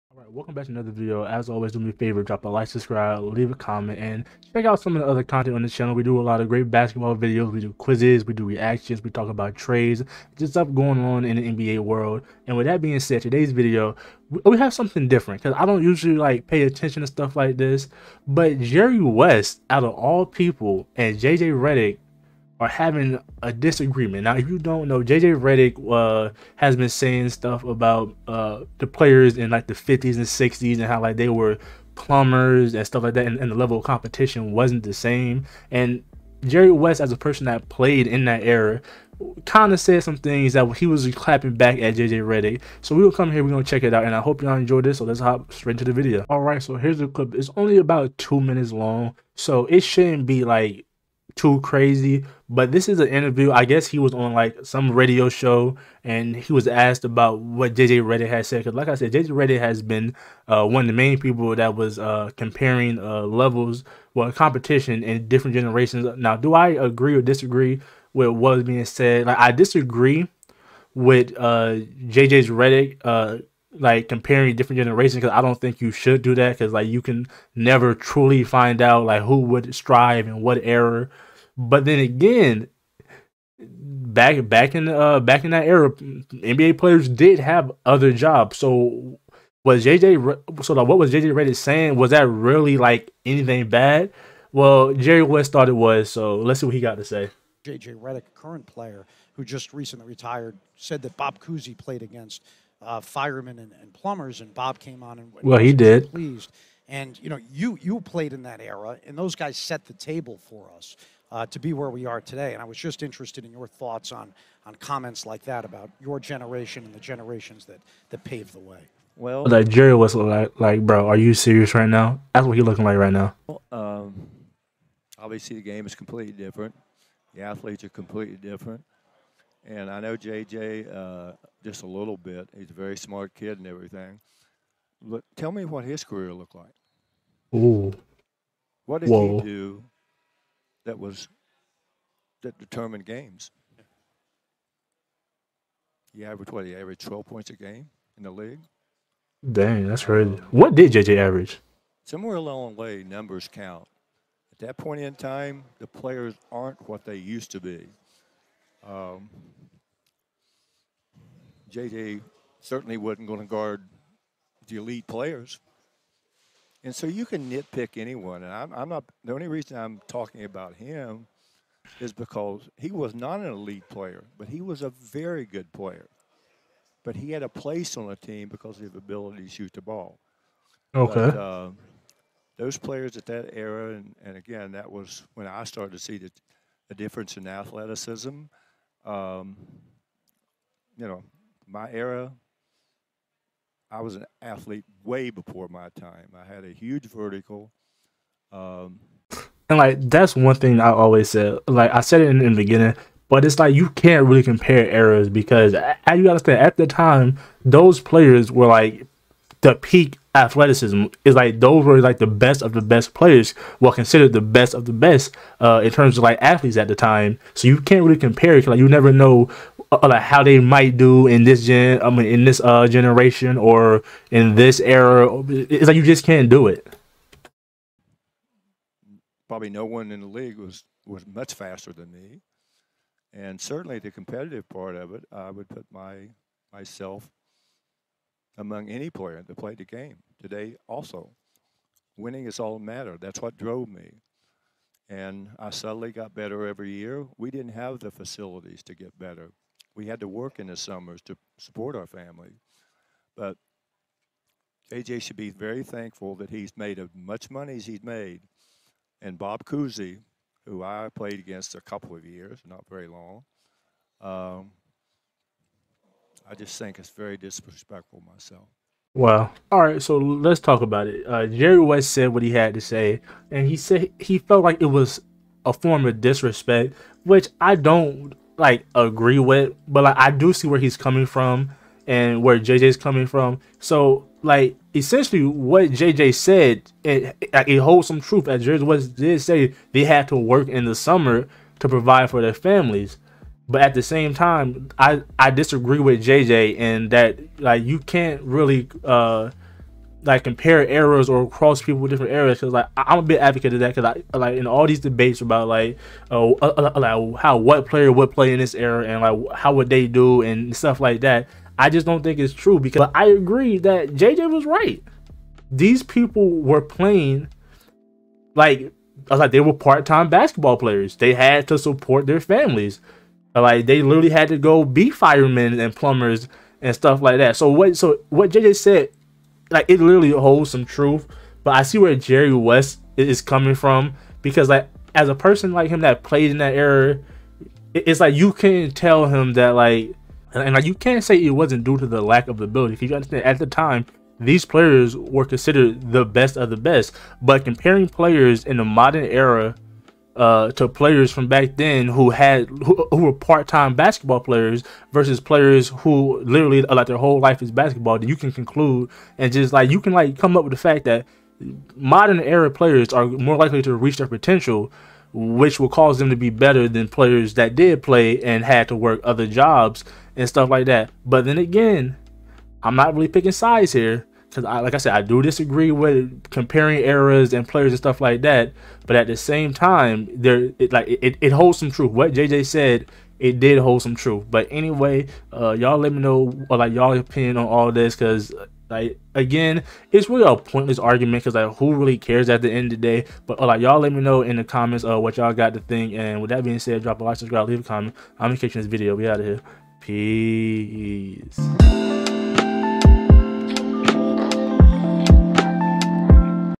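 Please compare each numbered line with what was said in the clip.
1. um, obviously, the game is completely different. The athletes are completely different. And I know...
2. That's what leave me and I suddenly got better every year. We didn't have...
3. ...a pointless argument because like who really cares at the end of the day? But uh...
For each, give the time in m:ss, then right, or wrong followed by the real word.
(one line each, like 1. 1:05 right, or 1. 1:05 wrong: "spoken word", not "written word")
1. 2:03 right
2. 4:03 wrong: "drove", not "leave"
3. 6:30 right.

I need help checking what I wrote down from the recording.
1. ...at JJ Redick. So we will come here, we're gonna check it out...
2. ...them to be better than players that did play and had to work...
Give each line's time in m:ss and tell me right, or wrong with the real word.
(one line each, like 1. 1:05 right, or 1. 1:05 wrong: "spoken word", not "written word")
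1. 0:41 right
2. 6:06 right.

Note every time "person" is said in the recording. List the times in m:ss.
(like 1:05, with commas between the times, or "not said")
0:37, 5:35.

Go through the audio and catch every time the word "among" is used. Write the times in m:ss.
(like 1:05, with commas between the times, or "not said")
3:58.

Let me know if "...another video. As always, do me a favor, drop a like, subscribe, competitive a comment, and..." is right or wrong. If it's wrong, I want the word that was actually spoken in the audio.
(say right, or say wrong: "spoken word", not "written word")
wrong: "leave", not "competitive".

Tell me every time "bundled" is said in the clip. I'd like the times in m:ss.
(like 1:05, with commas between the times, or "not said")
not said.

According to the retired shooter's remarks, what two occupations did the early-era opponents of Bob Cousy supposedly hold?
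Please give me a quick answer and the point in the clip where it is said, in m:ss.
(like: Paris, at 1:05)
firemen and plumbers, at 1:43.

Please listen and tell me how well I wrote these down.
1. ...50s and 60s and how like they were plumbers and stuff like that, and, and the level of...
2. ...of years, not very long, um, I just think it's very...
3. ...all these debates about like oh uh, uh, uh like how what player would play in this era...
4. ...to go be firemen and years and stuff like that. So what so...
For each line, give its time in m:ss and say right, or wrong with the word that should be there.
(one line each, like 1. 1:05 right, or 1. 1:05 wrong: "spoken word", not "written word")
1. 0:29 right
2. 4:22 right
3. 5:04 right
4. 5:24 wrong: "plumbers", not "years".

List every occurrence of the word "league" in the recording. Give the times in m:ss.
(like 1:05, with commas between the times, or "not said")
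2:28, 3:50.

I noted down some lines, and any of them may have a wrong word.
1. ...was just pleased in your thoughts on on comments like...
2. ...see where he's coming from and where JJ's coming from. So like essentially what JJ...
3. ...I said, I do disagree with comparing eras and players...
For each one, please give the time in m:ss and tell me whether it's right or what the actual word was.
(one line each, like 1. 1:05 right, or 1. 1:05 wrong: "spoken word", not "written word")
1. 1:52 wrong: "interested", not "pleased"
2. 4:40 right
3. 6:14 right.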